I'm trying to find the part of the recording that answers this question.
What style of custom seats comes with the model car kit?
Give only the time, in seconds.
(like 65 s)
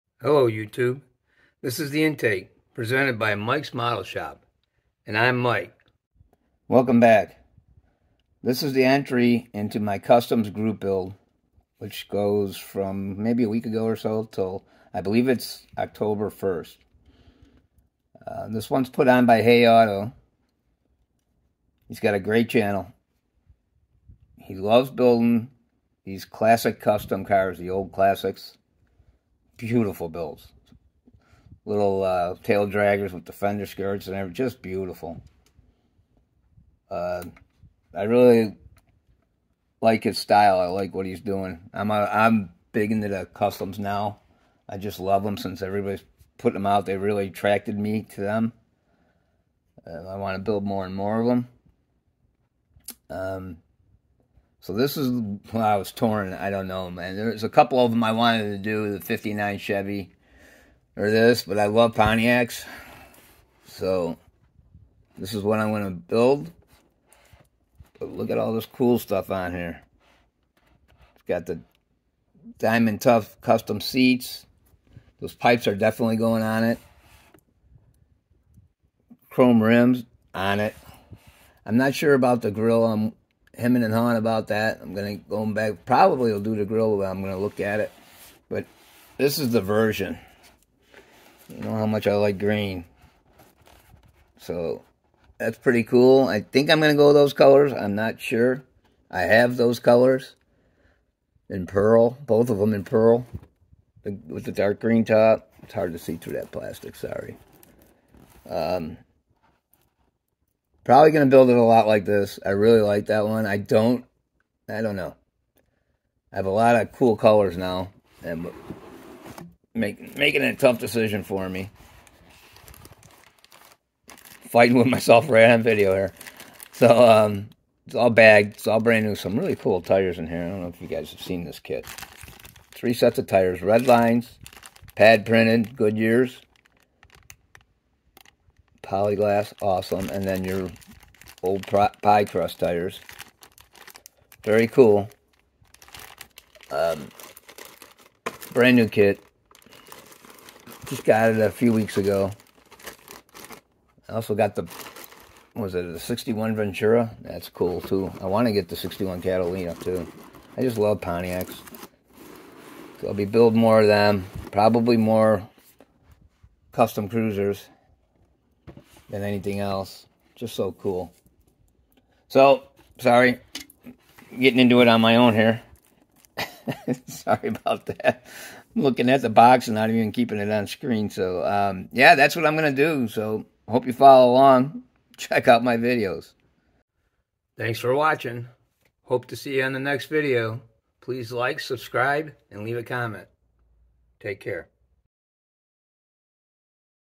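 72 s.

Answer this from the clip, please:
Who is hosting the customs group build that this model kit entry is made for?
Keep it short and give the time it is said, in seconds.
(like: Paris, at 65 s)
HayAuto, at 19 s.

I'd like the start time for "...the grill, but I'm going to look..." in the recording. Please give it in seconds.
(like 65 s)
86 s.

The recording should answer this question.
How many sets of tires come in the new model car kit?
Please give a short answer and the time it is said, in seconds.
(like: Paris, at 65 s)
3, at 132 s.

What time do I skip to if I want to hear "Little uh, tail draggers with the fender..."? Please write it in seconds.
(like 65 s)
31 s.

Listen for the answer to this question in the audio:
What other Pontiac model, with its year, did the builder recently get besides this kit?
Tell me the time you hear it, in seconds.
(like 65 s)
155 s.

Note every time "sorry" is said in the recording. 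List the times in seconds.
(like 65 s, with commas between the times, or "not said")
106 s, 172 s, 177 s.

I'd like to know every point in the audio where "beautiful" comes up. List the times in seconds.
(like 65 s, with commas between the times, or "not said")
29 s, 34 s.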